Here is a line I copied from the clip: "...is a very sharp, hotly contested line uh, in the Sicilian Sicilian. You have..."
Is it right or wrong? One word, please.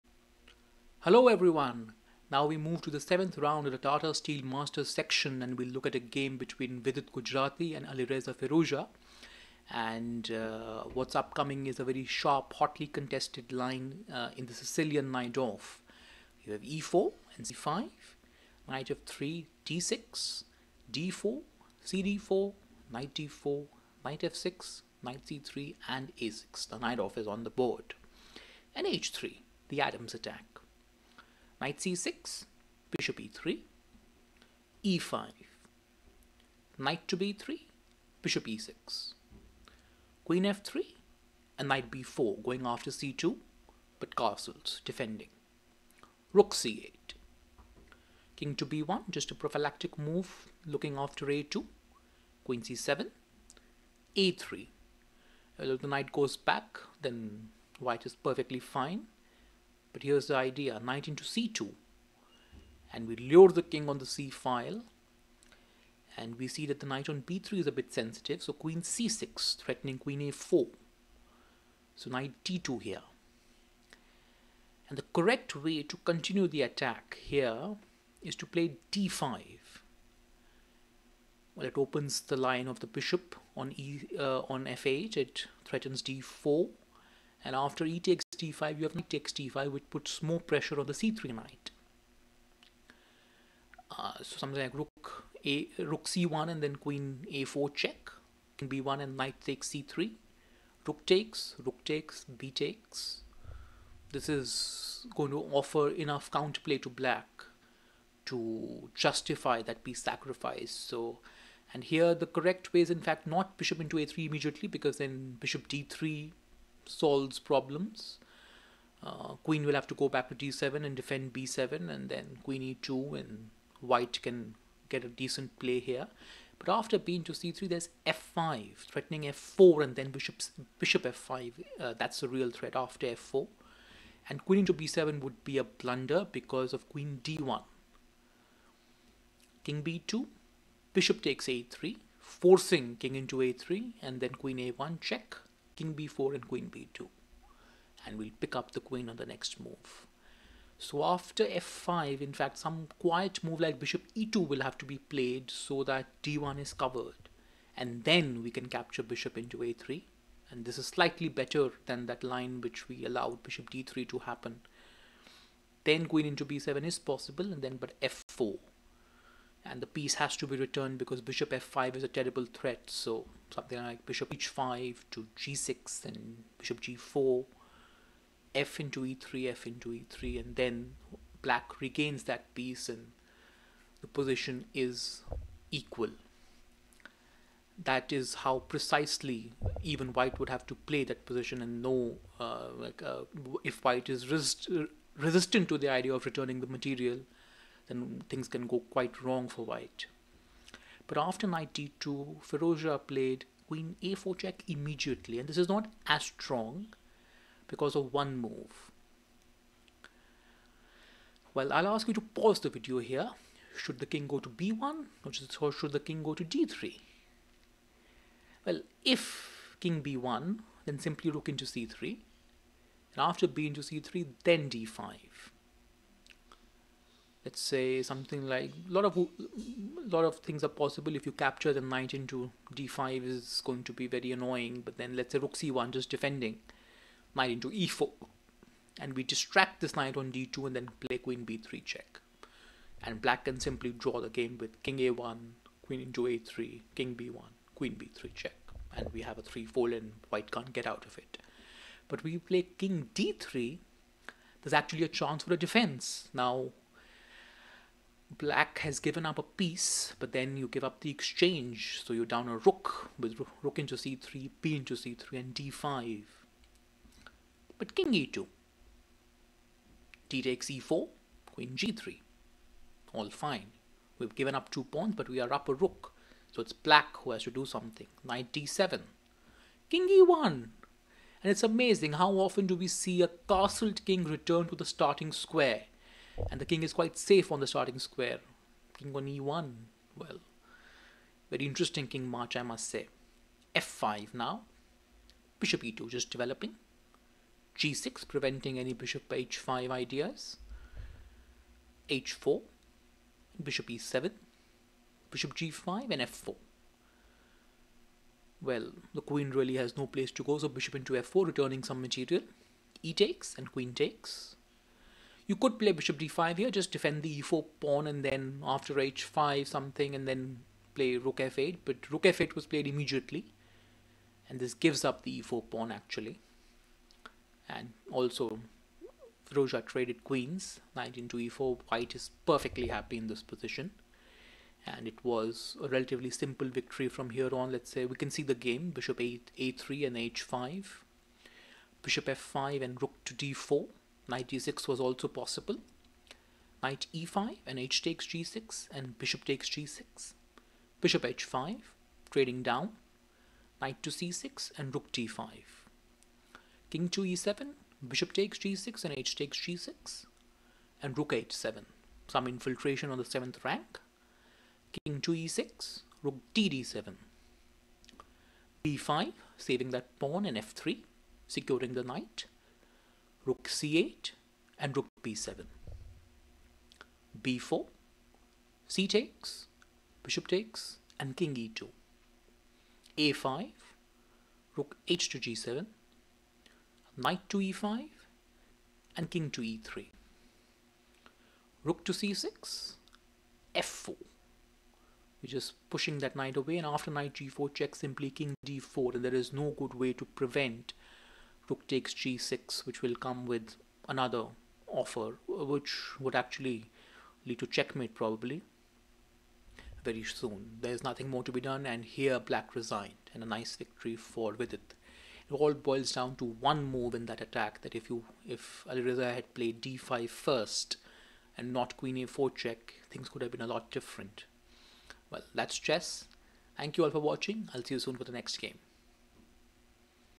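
wrong.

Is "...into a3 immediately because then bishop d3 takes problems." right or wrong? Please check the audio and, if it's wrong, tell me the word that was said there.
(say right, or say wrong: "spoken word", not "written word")
wrong: "solves", not "takes".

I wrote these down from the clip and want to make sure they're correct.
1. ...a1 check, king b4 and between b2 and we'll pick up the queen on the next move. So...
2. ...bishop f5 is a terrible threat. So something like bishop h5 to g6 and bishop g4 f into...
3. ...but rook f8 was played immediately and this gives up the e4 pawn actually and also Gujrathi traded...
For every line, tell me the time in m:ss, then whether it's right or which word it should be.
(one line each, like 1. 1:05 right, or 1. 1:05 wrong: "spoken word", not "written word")
1. 2:24 wrong: "queen", not "between"
2. 2:51 right
3. 5:21 wrong: "Roja", not "Gujrathi".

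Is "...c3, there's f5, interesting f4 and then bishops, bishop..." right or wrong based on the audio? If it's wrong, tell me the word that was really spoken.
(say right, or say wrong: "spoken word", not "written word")
wrong: "threatening", not "interesting".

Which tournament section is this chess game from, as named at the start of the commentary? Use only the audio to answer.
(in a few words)
Tata Steel Masters.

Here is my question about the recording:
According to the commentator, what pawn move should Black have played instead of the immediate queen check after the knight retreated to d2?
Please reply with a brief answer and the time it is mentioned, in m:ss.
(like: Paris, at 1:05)
d5, at 1:18.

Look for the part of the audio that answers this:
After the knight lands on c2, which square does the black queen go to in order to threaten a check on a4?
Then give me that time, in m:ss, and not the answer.
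1:08.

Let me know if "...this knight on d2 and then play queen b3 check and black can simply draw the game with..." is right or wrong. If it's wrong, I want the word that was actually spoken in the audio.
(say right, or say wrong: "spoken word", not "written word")
right.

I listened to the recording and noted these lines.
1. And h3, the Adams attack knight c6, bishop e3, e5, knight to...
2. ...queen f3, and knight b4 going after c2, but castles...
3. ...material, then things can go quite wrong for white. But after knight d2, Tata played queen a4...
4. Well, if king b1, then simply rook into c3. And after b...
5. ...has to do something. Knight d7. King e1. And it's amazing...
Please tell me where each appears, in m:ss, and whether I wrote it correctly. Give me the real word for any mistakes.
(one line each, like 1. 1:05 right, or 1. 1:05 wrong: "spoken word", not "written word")
1. 0:28 right
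2. 0:40 right
3. 3:16 wrong: "Firouzja", not "Tata"
4. 3:38 right
5. 4:37 right.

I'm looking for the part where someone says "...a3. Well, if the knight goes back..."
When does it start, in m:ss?
0:54.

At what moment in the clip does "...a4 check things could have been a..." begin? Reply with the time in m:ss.
7:02.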